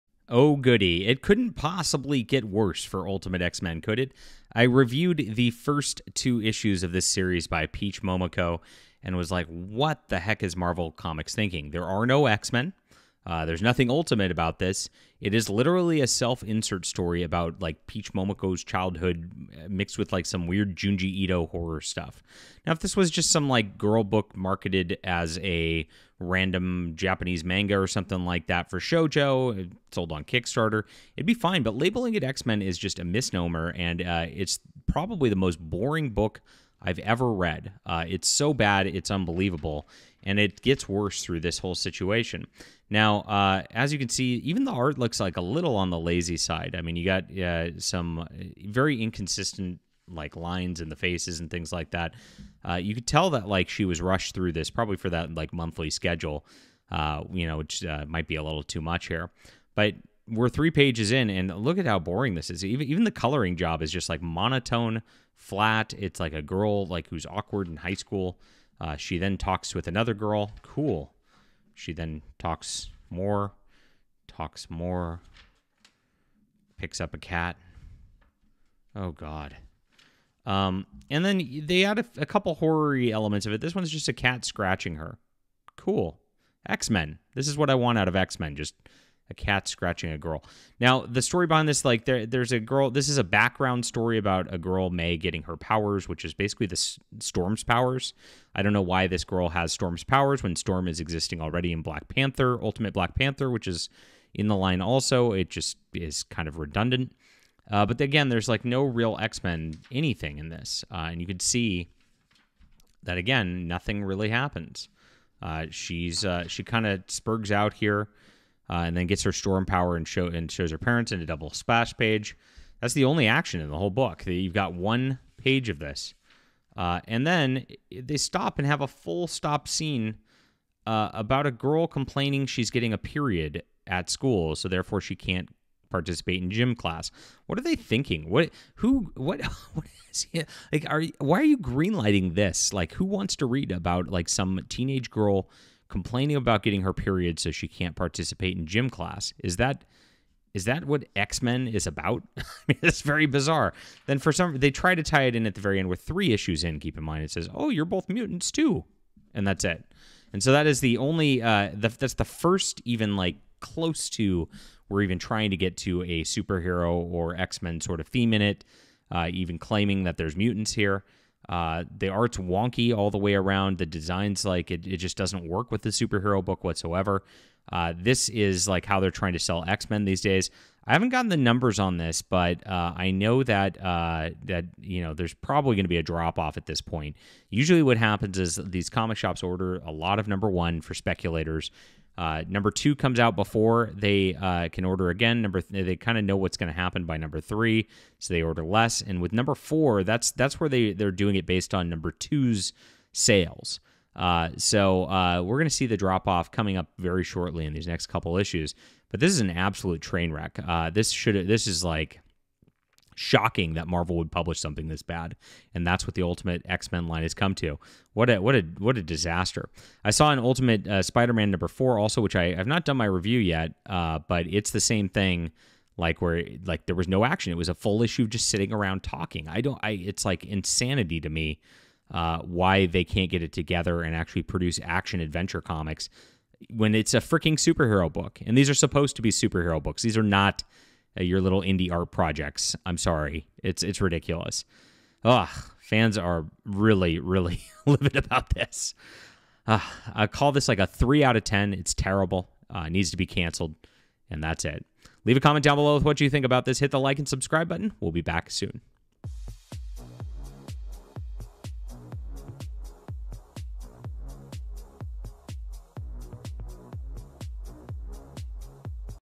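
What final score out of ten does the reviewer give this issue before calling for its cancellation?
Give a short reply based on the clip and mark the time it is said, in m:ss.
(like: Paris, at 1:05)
3 out of 10, at 4:10.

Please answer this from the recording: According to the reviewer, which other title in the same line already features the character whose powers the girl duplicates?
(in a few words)
Ultimate Black Panther.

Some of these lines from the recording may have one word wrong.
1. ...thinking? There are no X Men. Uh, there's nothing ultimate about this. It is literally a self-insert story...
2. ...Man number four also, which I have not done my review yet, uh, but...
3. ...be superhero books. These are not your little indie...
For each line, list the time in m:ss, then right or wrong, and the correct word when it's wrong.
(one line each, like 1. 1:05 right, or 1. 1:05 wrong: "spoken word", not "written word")
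1. 0:11 right
2. 3:41 right
3. 3:59 right.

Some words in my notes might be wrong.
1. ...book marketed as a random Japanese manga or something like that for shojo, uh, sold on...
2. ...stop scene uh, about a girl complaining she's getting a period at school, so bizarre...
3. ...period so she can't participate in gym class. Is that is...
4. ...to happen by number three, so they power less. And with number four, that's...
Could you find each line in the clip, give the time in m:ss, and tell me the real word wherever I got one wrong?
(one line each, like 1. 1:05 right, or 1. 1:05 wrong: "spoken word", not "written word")
1. 0:24 right
2. 2:09 wrong: "therefore", not "bizarre"
3. 2:26 right
4. 3:16 wrong: "order", not "power".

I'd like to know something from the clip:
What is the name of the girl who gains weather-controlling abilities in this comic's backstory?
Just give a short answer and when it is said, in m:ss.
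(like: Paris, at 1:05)
May, at 1:34.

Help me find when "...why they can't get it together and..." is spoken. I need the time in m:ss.
3:52.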